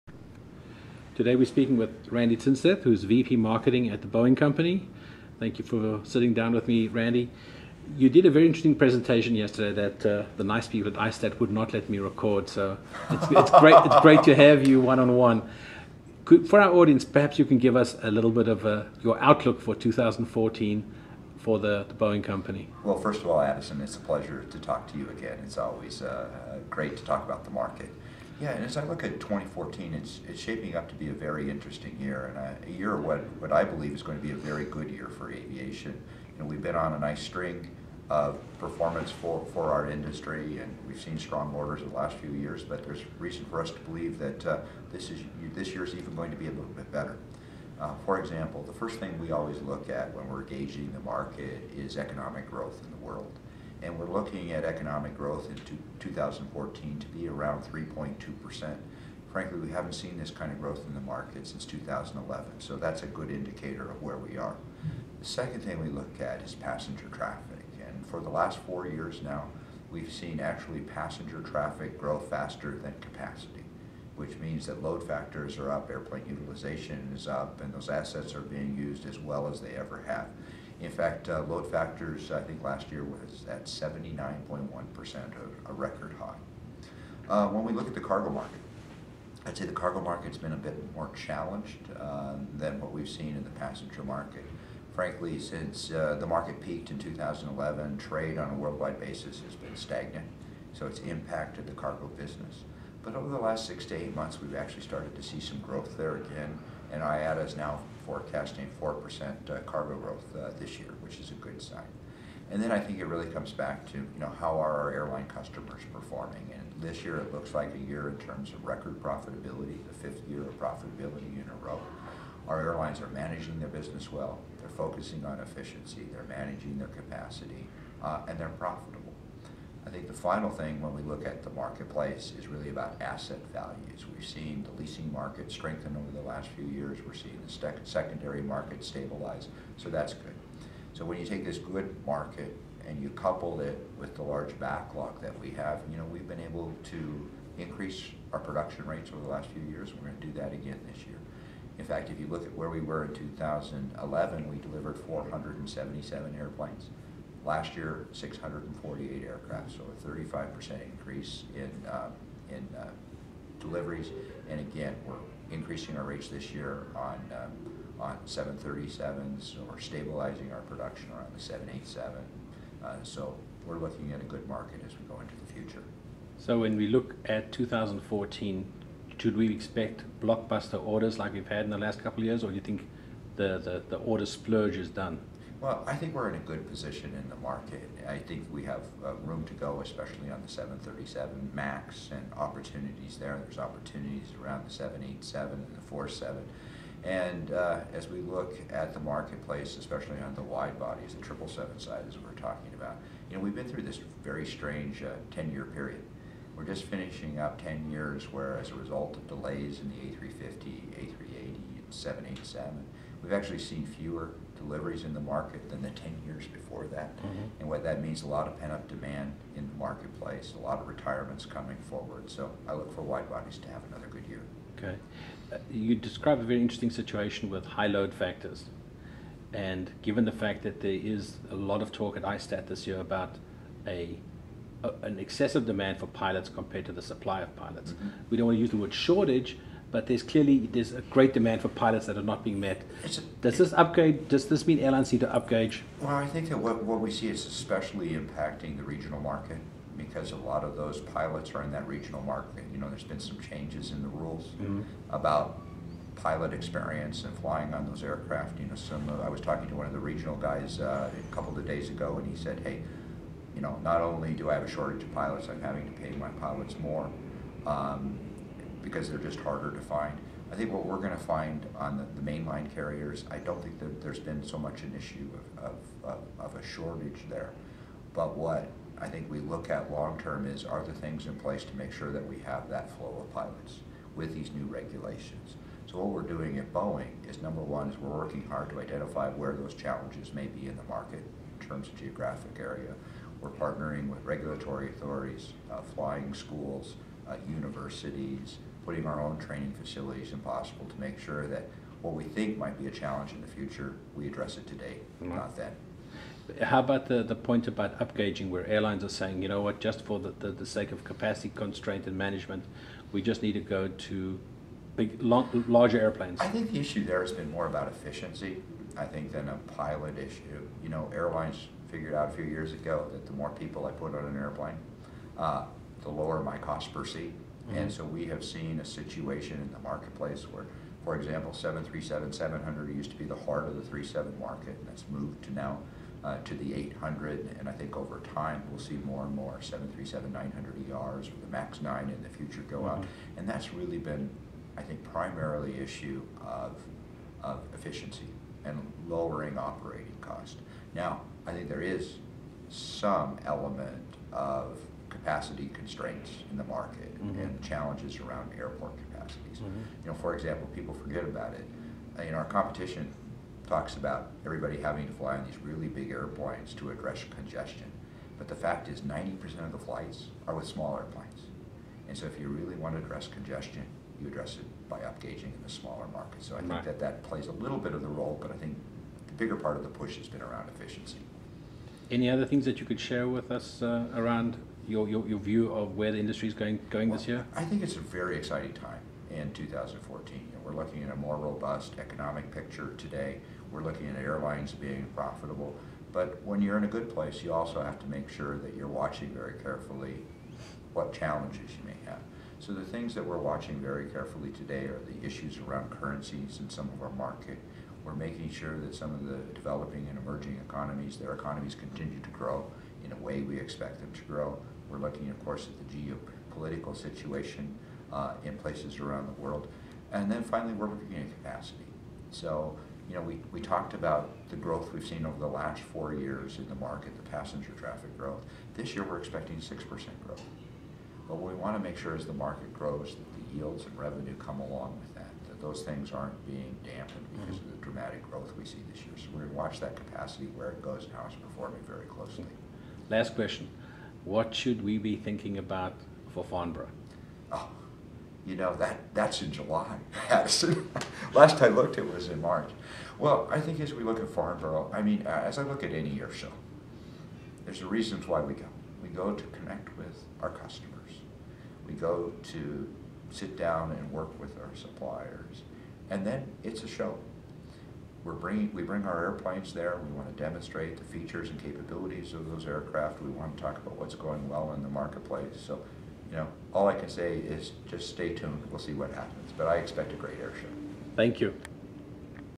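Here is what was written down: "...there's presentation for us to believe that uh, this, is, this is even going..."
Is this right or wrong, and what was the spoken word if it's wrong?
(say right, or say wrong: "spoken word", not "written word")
wrong: "reason", not "presentation".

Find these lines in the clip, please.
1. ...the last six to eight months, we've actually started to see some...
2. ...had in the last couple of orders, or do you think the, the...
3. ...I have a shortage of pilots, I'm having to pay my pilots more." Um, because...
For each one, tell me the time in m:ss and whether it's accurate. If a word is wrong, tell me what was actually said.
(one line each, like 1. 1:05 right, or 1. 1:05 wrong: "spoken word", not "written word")
1. 1:43 right
2. 3:01 wrong: "years", not "orders"
3. 4:24 right.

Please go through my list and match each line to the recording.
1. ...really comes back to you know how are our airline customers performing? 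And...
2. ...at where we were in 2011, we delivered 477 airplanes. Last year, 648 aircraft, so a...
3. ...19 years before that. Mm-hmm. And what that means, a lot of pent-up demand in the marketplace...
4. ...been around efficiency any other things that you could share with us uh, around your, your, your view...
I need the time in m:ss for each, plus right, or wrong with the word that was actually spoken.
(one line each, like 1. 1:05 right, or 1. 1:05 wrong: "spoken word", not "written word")
1. 1:53 right
2. 2:32 right
3. 3:35 wrong: "10", not "19"
4. 6:20 right.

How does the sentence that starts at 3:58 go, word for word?
we don't want to use the word shortage, but there's clearly there's a great demand for pilots that are not being met.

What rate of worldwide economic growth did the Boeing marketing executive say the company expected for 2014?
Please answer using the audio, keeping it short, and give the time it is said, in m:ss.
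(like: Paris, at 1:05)
3.2%, at 0:57.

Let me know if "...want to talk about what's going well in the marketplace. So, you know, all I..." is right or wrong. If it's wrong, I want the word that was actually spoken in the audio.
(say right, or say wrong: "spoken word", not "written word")
right.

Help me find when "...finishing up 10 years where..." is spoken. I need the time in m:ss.
3:26.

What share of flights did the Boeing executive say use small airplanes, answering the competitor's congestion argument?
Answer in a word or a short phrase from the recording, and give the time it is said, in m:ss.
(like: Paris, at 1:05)
90%, at 6:09.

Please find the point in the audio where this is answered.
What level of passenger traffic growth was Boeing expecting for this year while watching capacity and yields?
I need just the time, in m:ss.
7:09.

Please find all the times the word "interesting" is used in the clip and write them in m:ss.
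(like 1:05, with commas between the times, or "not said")
0:08, 0:31, 3:46.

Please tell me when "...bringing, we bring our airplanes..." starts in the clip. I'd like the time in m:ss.
7:48.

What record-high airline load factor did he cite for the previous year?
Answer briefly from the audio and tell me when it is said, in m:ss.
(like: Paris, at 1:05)
79.1%, at 1:23.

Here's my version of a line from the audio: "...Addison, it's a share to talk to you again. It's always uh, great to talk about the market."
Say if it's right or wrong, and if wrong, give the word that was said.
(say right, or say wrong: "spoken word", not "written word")
wrong: "pleasure", not "share".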